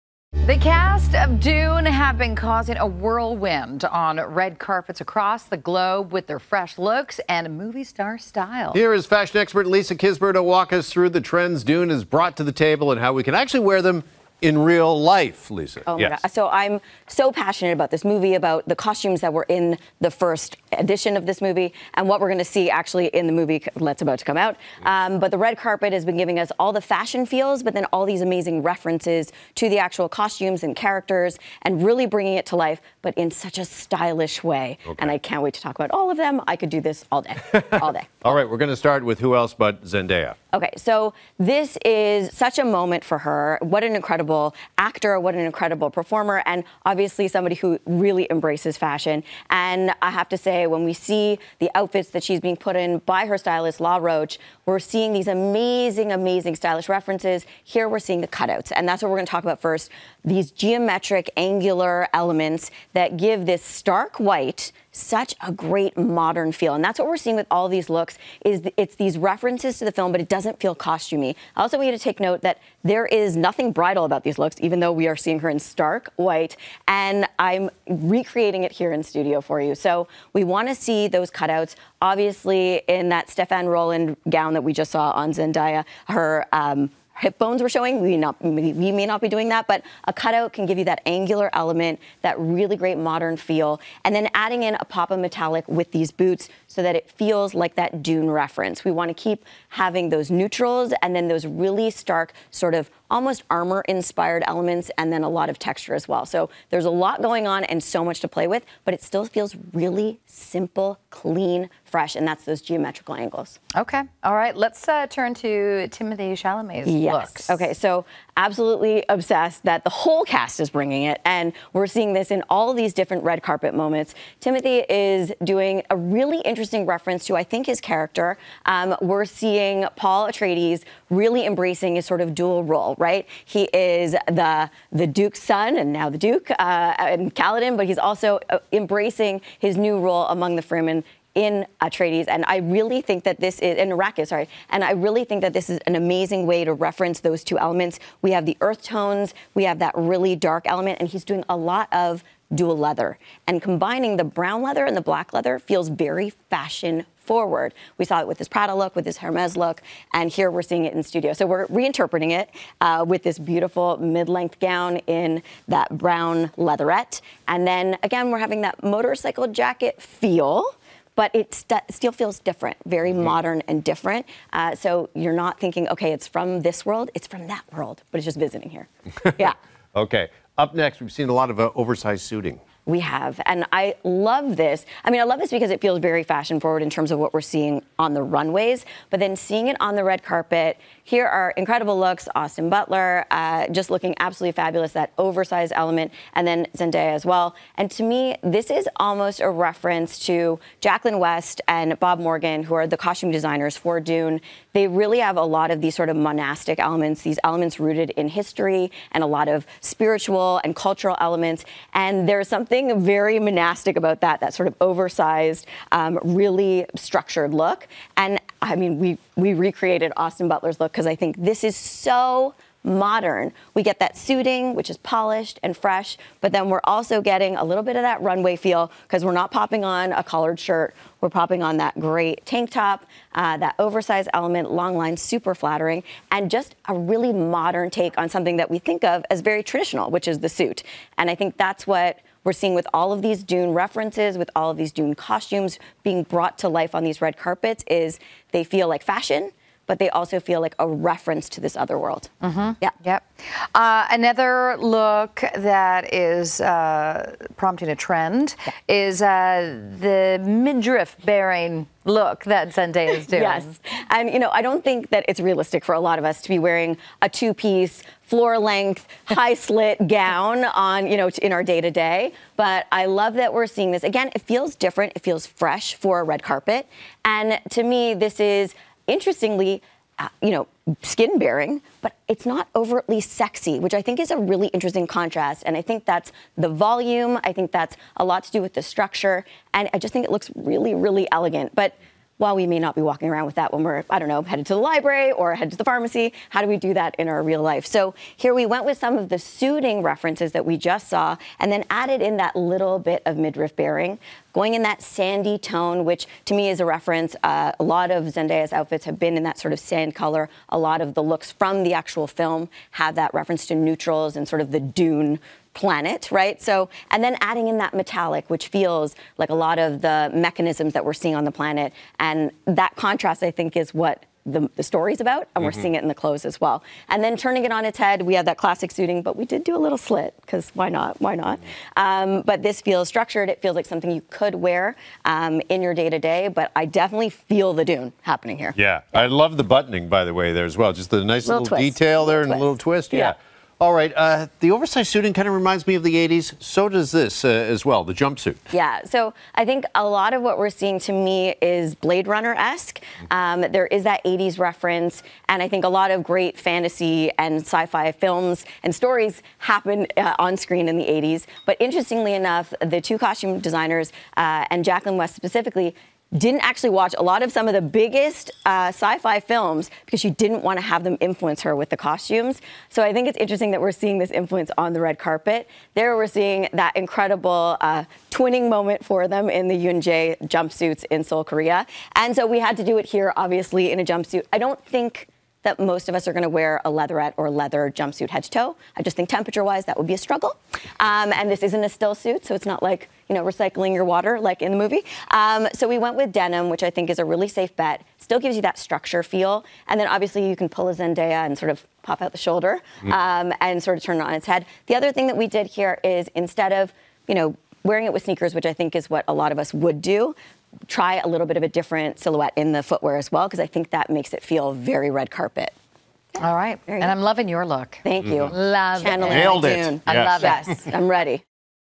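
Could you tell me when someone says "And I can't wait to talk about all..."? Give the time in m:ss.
0:34.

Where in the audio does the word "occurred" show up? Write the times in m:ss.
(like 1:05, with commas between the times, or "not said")
not said.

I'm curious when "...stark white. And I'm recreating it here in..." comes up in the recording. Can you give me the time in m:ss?
1:15.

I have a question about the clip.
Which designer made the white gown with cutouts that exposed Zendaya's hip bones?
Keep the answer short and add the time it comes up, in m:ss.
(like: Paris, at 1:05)
Stéphane Rolland, at 1:23.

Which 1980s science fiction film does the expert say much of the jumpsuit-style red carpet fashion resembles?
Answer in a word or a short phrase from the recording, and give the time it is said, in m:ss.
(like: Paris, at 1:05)
Blade Runner, at 5:51.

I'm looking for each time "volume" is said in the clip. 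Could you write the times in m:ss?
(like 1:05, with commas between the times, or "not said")
4:46.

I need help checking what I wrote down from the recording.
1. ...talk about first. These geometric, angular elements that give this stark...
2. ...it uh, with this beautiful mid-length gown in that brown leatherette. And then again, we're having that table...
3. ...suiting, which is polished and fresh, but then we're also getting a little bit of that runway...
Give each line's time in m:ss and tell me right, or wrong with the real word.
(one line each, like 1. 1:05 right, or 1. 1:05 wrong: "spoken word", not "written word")
1. 0:59 right
2. 2:42 wrong: "motorcycle", not "table"
3. 3:44 right.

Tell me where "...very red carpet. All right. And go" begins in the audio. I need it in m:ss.
6:54.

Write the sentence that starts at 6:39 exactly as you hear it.
And then obviously you can pull a Zendaya and sort of pop out the shoulder mm.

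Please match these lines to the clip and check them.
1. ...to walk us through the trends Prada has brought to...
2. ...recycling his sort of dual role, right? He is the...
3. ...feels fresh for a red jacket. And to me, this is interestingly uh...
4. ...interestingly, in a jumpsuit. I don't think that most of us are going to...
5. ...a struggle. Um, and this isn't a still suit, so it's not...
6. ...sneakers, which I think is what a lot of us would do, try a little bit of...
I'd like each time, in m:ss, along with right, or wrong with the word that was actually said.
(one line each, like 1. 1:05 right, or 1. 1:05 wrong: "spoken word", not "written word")
1. 0:10 wrong: "Dune", not "Prada"
2. 2:11 wrong: "embracing", not "recycling"
3. 4:35 wrong: "carpet", not "jacket"
4. 6:23 wrong: "obviously", not "interestingly"
5. 6:30 right
6. 6:48 right.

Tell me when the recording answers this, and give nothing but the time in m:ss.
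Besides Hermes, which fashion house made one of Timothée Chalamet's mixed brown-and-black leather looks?
2:38.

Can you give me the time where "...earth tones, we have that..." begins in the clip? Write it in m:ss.
2:28.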